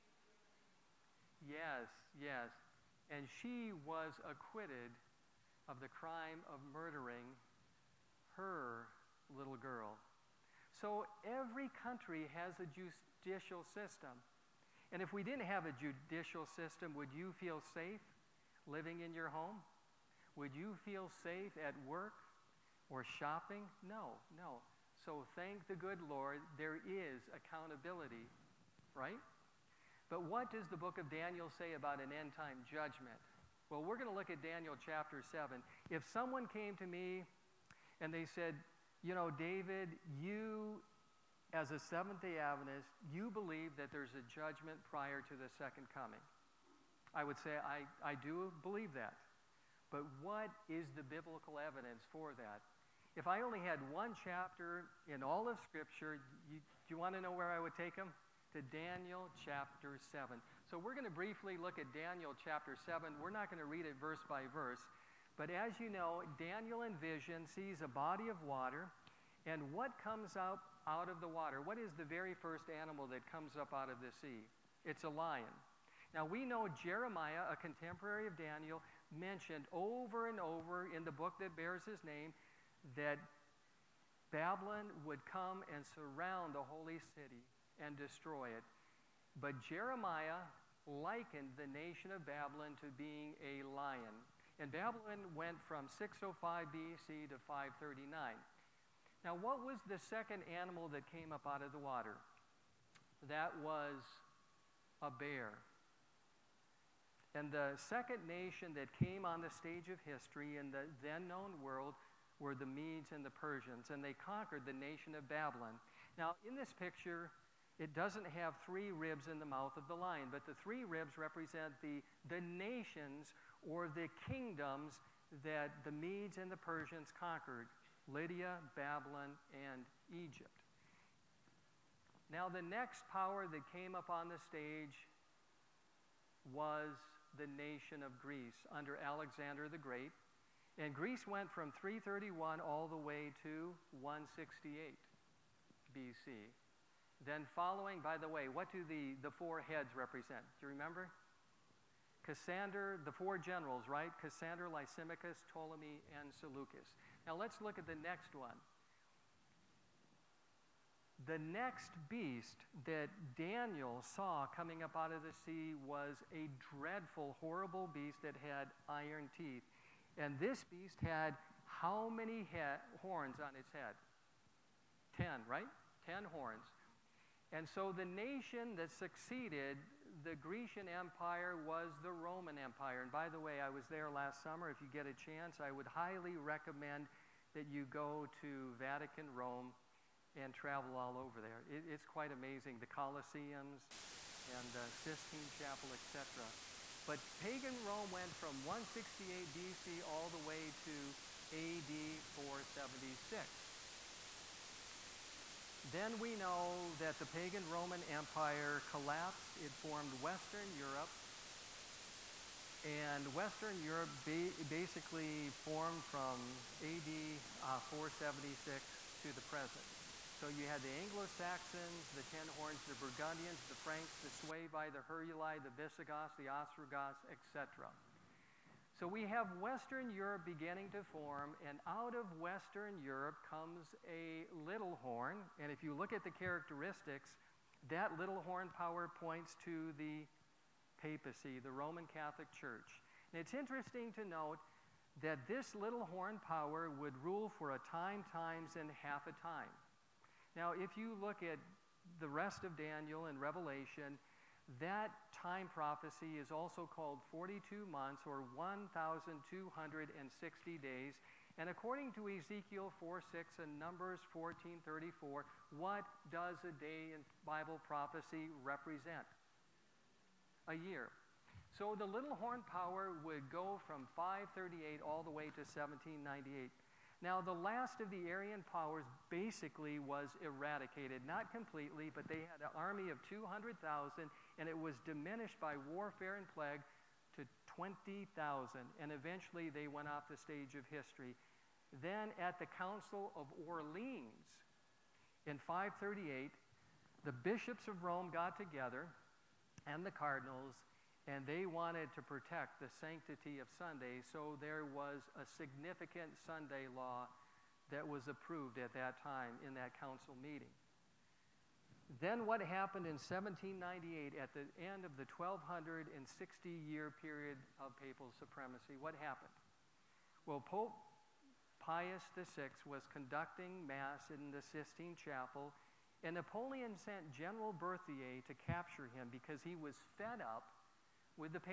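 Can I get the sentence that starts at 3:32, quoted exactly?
And Western Europe ba basically formed from AD uh, 476 to the present.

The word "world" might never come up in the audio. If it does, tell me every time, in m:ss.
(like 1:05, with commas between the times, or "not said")
1:51.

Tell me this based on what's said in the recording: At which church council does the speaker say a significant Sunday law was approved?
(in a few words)
Council of Orleans.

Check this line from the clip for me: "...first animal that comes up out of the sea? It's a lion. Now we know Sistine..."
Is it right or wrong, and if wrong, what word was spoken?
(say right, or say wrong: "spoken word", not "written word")
wrong: "Jeremiah", not "Sistine".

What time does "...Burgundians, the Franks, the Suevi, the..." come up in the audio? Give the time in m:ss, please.
3:42.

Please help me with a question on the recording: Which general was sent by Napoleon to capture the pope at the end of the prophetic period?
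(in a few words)
General Berthier.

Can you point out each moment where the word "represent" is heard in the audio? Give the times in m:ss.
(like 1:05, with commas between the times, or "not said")
2:01, 2:29, 4:28.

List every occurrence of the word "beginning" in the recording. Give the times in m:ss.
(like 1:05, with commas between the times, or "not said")
3:50.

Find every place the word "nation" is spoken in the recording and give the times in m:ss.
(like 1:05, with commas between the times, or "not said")
1:31, 1:48, 1:54, 2:02, 2:17, 2:58.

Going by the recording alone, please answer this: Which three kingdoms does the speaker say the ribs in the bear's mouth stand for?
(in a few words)
Lydia, Babylon, and Egypt.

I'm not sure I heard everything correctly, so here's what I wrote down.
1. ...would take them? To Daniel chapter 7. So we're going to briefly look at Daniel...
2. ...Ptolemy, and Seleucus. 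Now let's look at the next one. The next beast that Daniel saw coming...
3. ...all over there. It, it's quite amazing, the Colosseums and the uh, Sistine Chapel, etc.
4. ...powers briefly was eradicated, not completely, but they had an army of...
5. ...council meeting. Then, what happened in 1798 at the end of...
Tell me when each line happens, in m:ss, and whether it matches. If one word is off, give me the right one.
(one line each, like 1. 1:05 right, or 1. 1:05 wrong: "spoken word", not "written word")
1. 0:57 right
2. 2:35 right
3. 3:10 right
4. 4:38 wrong: "basically", not "briefly"
5. 5:09 right.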